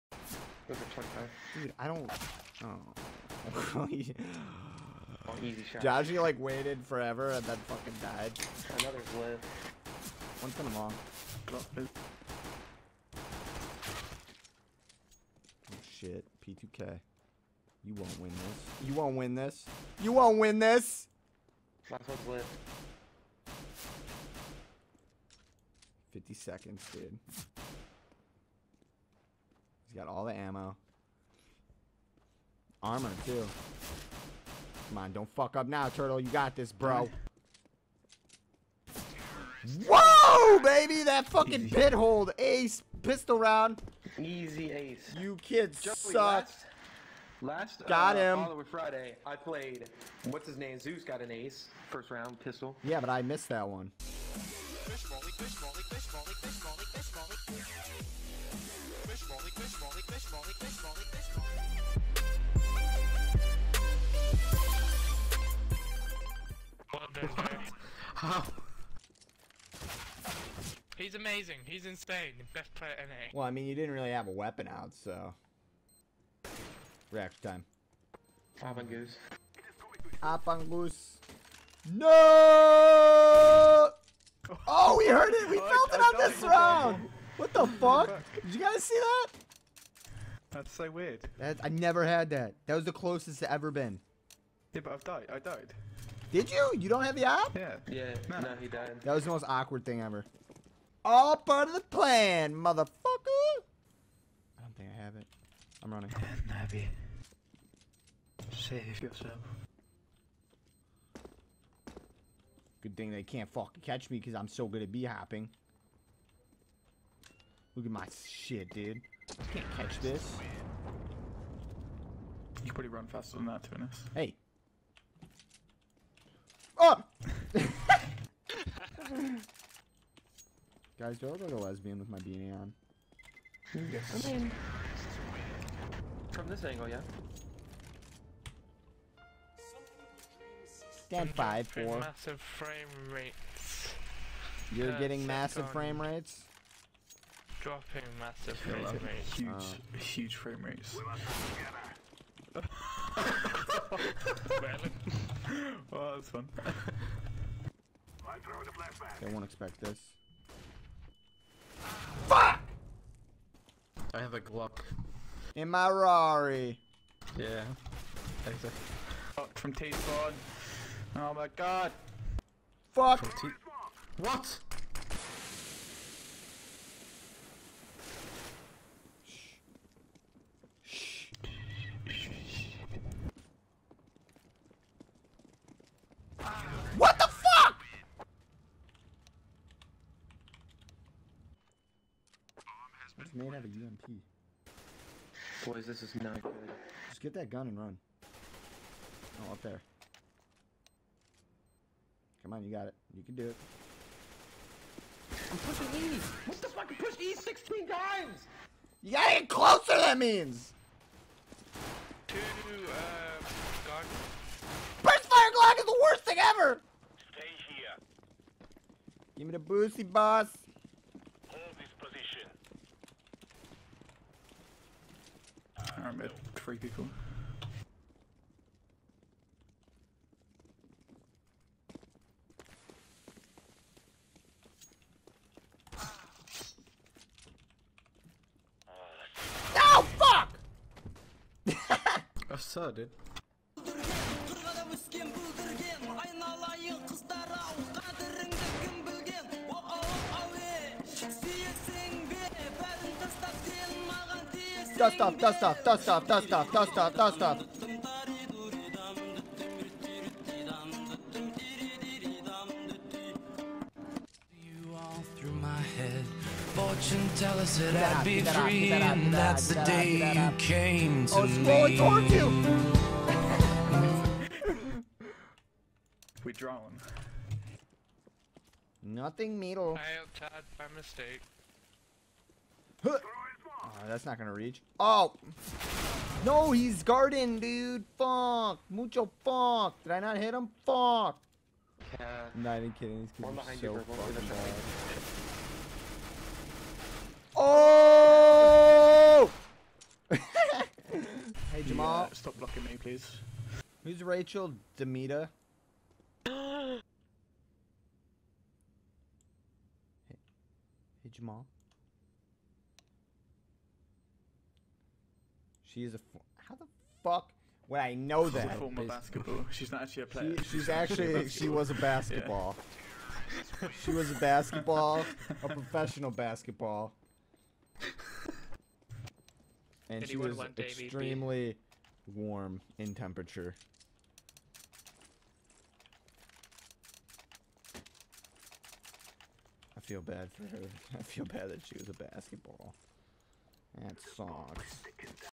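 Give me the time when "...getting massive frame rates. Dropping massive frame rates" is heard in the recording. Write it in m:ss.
2:24.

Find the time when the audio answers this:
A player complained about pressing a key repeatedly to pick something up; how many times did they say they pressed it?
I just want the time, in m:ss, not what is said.
3:27.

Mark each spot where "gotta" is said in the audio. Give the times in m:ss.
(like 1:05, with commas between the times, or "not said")
3:29.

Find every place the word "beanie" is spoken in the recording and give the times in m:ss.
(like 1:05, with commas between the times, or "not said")
2:12.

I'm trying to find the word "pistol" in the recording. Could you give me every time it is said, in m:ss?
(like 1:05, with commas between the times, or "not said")
0:43, 0:52.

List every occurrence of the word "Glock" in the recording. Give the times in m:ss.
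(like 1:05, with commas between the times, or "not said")
2:44, 3:35.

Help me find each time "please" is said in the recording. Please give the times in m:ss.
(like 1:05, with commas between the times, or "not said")
5:02.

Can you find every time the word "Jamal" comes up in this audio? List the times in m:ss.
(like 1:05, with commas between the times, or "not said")
5:01, 5:11.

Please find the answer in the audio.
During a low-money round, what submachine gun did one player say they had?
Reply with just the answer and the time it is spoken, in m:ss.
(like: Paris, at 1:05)
UMP, at 3:13.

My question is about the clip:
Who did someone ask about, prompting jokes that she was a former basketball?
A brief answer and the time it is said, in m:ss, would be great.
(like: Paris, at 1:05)
Rachel DeMita, at 5:04.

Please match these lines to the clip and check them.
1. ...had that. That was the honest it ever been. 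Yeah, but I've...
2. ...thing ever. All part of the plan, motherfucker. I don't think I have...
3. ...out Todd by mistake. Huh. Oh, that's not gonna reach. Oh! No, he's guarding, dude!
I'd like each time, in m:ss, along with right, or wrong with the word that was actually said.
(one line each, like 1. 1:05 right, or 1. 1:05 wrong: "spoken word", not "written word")
1. 1:32 wrong: "closest", not "honest"
2. 1:39 right
3. 4:40 right.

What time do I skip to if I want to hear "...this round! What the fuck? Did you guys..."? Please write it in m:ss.
1:26.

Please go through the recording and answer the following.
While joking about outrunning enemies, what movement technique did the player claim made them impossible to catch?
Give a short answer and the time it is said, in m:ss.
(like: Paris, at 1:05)
b-hopping, at 1:54.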